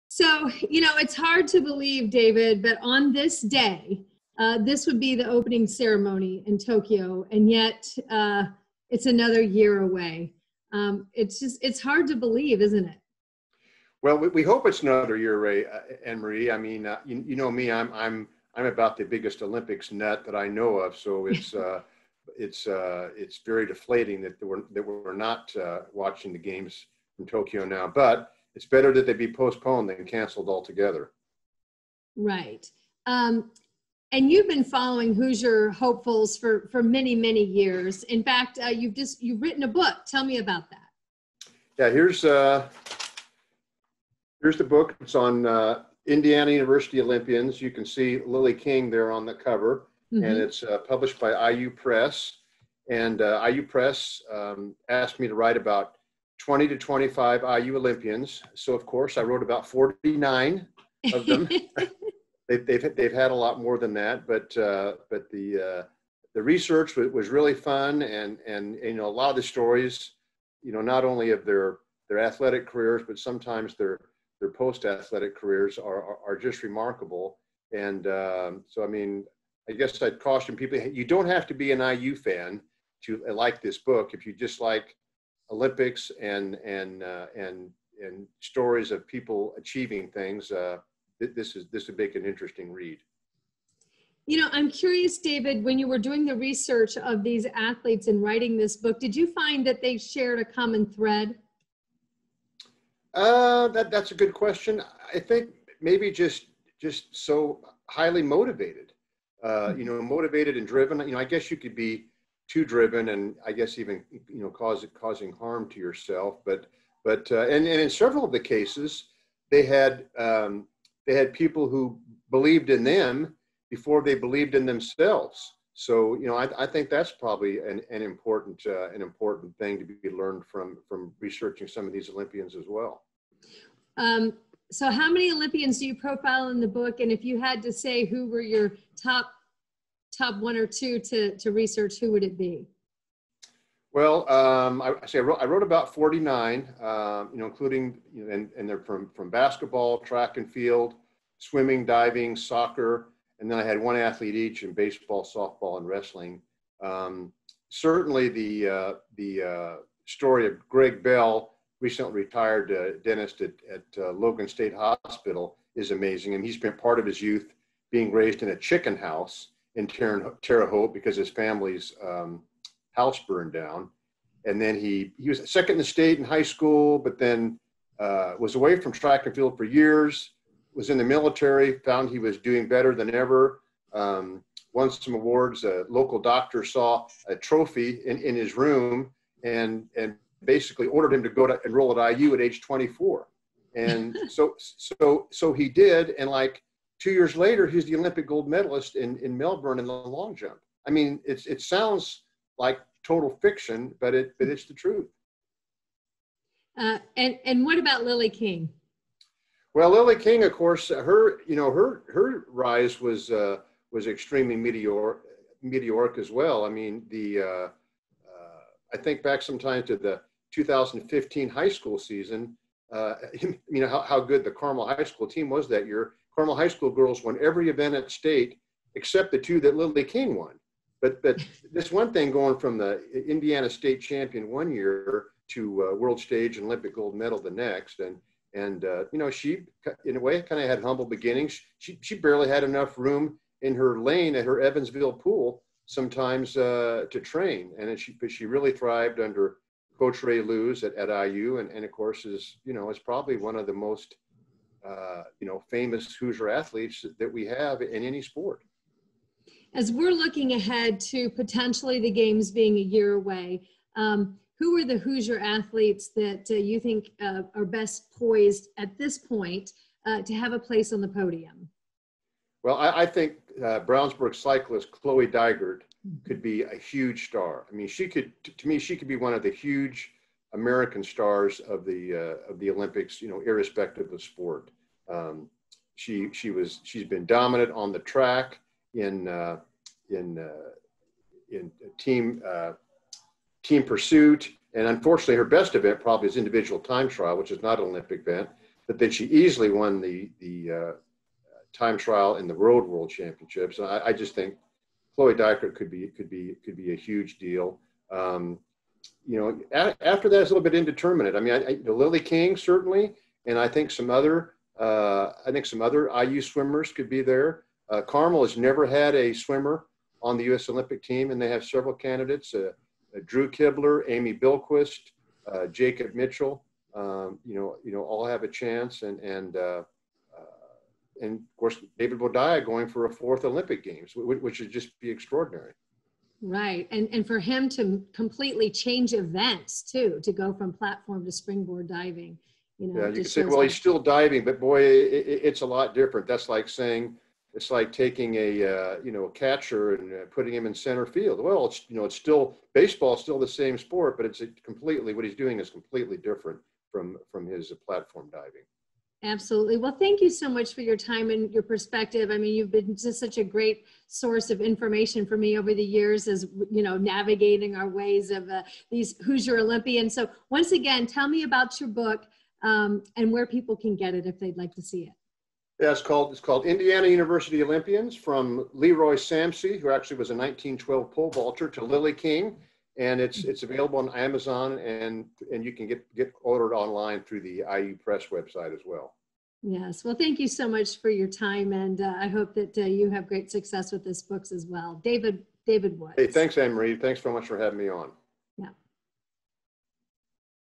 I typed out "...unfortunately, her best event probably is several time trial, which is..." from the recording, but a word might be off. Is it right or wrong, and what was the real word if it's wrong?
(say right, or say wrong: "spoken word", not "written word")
wrong: "individual", not "several".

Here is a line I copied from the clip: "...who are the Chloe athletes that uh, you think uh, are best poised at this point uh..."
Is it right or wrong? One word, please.
wrong.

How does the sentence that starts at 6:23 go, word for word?
it's available on Amazon and and you can get get ordered online through the IU Press website as well.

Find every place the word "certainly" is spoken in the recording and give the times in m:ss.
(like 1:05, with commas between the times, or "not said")
2:37, 5:12.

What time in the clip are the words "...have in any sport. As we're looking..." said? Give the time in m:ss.
4:17.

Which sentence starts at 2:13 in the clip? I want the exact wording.
Um, so how many Olympians do you profile in the book?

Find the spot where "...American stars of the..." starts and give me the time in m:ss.
4:40.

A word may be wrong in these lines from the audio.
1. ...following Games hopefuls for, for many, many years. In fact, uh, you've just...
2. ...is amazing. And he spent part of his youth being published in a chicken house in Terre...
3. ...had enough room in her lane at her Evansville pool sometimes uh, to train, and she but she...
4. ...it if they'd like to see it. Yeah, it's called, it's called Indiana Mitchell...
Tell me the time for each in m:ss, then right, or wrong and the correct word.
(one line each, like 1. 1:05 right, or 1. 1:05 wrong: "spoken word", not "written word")
1. 0:34 wrong: "Hoosier", not "Games"
2. 2:45 wrong: "raised", not "published"
3. 4:02 right
4. 6:14 wrong: "University", not "Mitchell".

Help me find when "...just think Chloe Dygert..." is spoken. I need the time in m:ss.
5:04.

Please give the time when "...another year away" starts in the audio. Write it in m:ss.
0:09.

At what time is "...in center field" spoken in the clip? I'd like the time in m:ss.
5:50.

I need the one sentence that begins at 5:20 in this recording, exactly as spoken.
Olympic team, and they have several candidates: uh, uh Drew Kibler, Amy Bilquist, uh, Jacob Mitchell.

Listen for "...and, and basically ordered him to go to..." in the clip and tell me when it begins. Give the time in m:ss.
3:09.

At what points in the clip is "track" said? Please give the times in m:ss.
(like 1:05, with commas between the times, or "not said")
2:29, 2:58, 4:47.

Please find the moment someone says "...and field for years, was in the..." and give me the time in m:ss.
2:59.